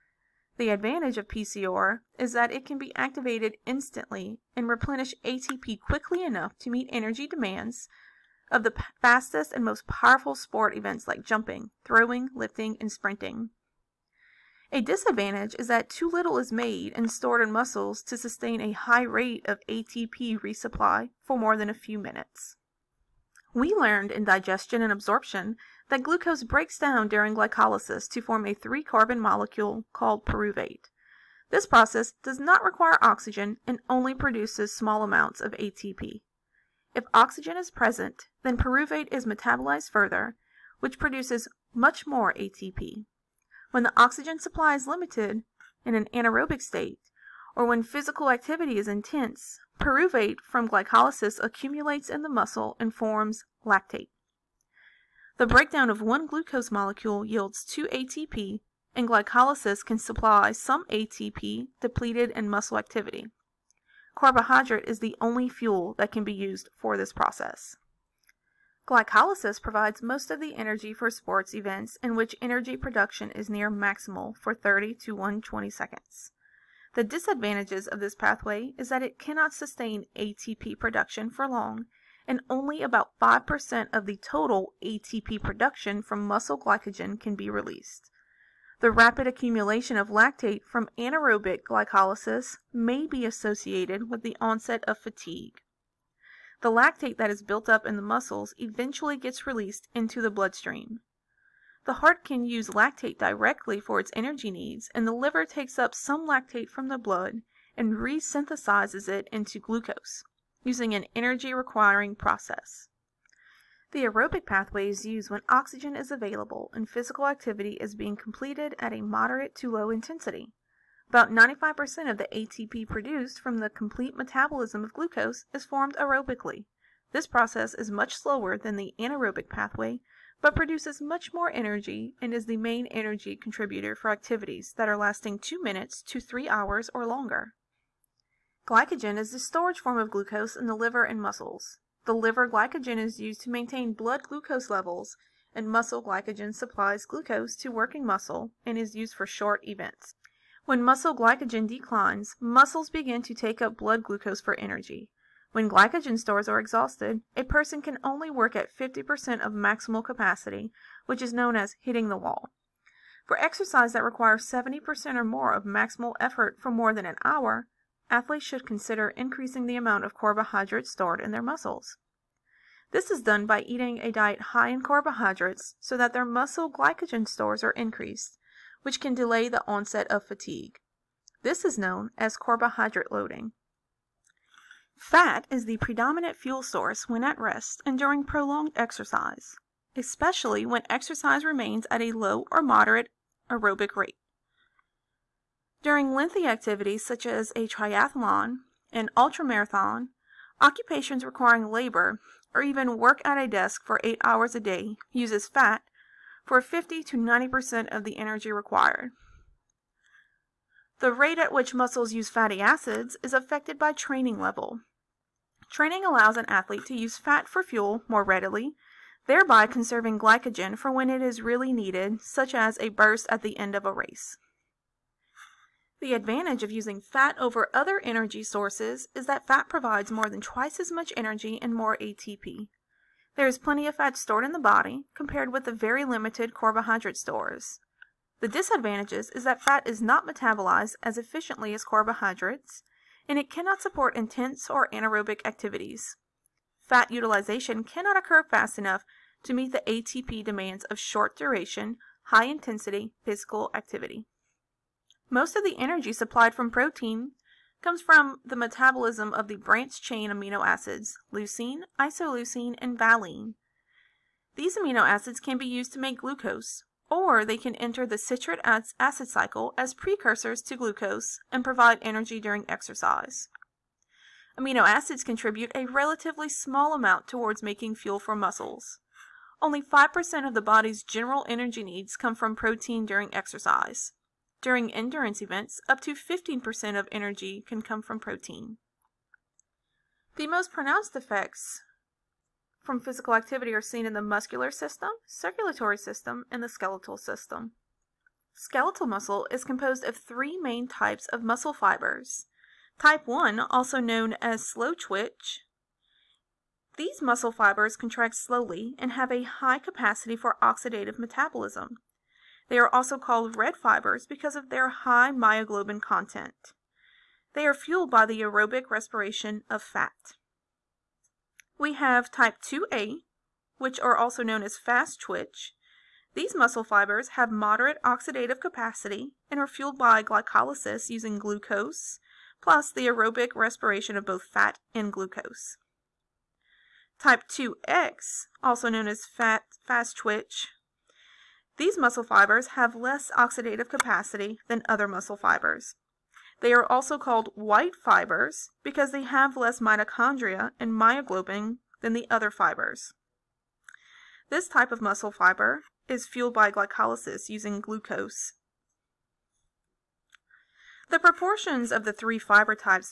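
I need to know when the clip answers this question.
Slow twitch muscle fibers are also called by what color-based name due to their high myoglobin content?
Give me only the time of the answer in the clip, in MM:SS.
05:13.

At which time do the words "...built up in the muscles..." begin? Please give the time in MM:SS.
01:37.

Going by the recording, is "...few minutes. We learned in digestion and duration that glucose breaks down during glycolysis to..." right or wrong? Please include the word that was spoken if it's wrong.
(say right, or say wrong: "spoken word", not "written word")
wrong: "absorption", not "duration".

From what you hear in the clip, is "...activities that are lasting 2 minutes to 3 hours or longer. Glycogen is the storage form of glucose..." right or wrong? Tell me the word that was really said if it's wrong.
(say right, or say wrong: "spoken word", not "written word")
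right.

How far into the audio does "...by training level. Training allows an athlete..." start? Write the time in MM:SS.
03:33.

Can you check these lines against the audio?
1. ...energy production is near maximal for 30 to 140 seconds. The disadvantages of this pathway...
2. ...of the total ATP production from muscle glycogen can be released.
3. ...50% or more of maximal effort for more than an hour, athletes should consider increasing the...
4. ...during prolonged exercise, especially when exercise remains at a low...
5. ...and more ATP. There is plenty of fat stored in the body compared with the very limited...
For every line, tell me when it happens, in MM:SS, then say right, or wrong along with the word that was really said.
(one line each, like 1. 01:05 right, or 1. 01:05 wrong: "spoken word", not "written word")
1. 01:12 wrong: "120", not "140"
2. 01:23 right
3. 02:44 wrong: "70", not "50"
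4. 03:07 right
5. 03:51 right.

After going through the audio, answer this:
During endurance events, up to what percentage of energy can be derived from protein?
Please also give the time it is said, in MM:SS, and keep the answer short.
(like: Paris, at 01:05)
15%, at 04:45.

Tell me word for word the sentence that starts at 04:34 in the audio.
Amino acids contribute a relatively small amount towards making fuel for muscles.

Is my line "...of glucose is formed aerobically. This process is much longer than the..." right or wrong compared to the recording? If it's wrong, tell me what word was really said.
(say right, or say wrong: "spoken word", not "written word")
wrong: "slower", not "longer".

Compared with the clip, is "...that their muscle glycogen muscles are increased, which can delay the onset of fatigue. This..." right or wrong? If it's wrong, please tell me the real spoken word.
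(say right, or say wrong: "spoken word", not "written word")
wrong: "stores", not "muscles".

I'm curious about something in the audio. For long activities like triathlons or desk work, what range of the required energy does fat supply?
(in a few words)
50 to 90%.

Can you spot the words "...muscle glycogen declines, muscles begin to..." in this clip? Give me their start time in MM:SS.
02:30.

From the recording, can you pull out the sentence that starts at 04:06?
Fat utilization cannot occur fast enough to meet the ATP demands of short duration, high intensity physical activity.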